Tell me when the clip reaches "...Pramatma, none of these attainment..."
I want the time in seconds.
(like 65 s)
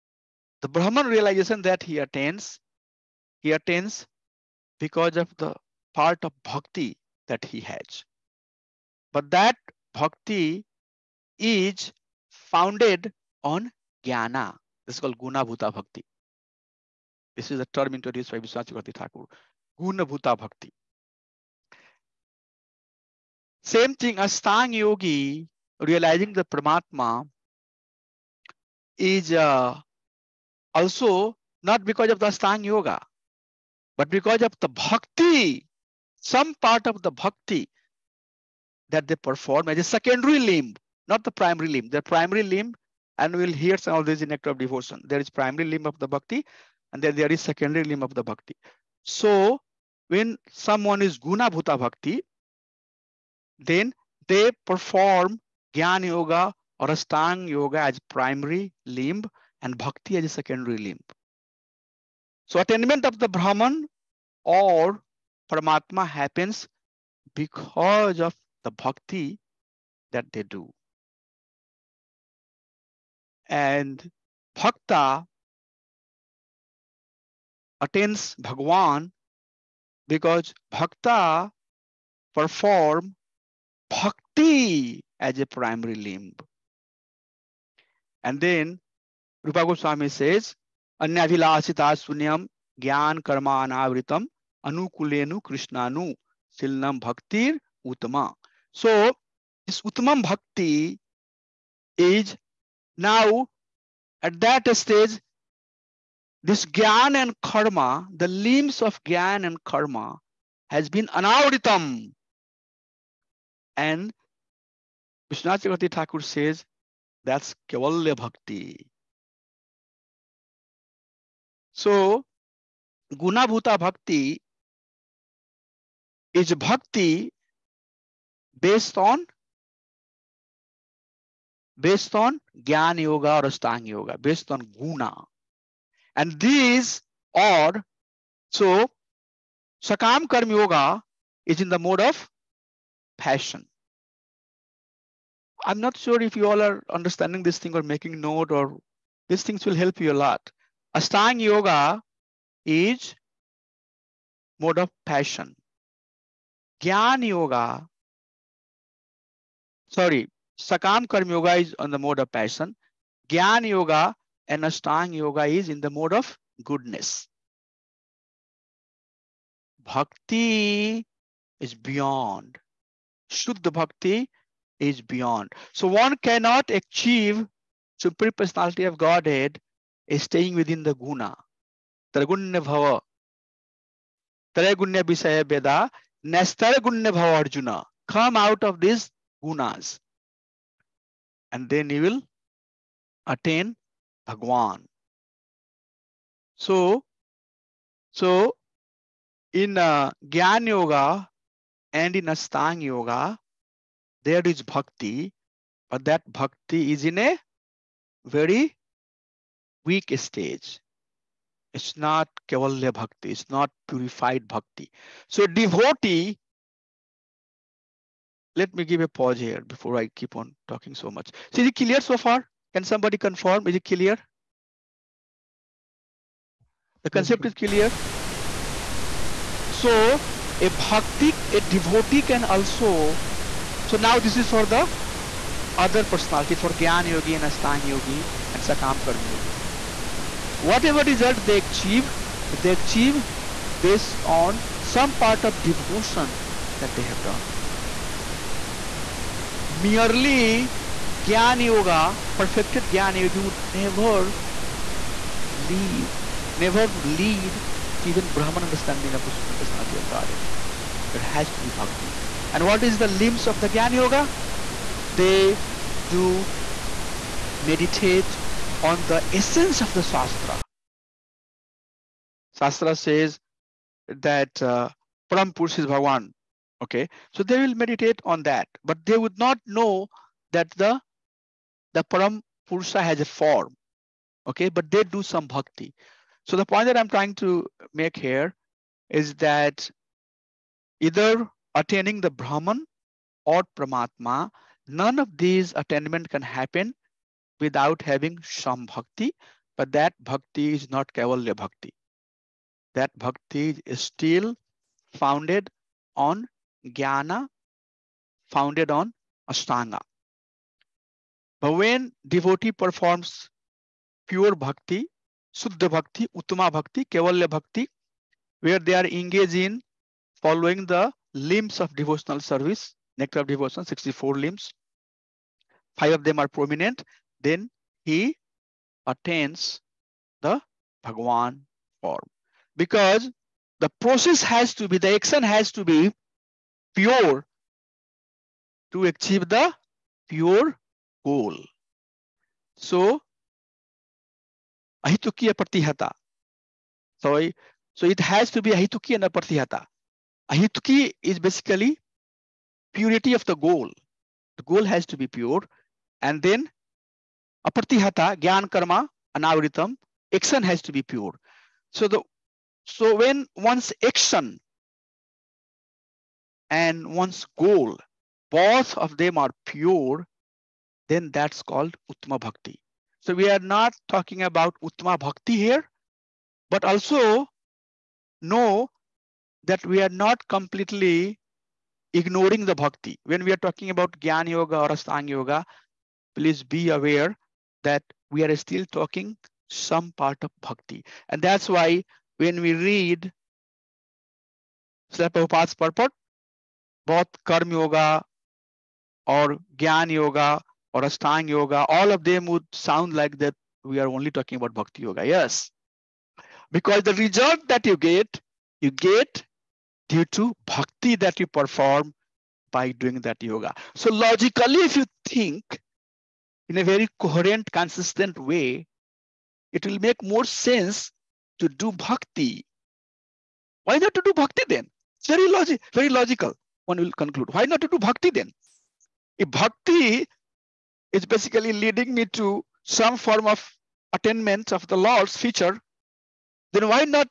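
293 s.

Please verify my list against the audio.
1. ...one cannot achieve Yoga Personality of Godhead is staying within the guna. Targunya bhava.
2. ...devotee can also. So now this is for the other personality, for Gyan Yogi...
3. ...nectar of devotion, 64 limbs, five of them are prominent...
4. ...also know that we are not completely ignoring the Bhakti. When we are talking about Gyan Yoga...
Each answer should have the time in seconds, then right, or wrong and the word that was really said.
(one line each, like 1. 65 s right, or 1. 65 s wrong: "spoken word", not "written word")
1. 175 s wrong: "Supreme", not "Yoga"
2. 231 s right
3. 323 s right
4. 376 s right.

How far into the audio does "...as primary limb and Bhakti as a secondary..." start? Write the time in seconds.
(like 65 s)
57 s.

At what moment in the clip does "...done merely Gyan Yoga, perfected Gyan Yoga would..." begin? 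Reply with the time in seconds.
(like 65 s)
247 s.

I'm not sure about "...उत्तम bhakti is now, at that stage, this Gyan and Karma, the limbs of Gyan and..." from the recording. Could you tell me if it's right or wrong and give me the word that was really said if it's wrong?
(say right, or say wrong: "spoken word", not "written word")
right.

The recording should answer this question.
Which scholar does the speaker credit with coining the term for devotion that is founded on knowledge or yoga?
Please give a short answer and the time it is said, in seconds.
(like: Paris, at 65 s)
Vishwanath Chakravarti Thakur, at 18 s.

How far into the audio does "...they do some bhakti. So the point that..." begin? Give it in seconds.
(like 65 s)
284 s.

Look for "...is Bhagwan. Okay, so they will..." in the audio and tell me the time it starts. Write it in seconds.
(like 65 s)
275 s.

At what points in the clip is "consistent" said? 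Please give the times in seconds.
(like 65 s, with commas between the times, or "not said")
417 s.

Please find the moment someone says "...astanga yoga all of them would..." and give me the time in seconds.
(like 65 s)
401 s.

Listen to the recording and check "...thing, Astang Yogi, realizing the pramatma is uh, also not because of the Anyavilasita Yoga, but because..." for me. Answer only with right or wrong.
wrong.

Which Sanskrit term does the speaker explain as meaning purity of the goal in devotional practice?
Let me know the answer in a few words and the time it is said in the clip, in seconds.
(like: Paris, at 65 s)
Ahituki, at 350 s.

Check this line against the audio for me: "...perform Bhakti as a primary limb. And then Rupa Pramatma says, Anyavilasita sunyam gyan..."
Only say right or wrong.
wrong.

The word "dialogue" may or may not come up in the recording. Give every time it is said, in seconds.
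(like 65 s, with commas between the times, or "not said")
not said.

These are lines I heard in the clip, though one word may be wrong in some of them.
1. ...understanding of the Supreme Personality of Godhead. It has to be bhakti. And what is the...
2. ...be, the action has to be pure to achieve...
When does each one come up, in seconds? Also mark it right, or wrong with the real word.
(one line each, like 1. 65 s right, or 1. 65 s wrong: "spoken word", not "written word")
1. 258 s right
2. 334 s right.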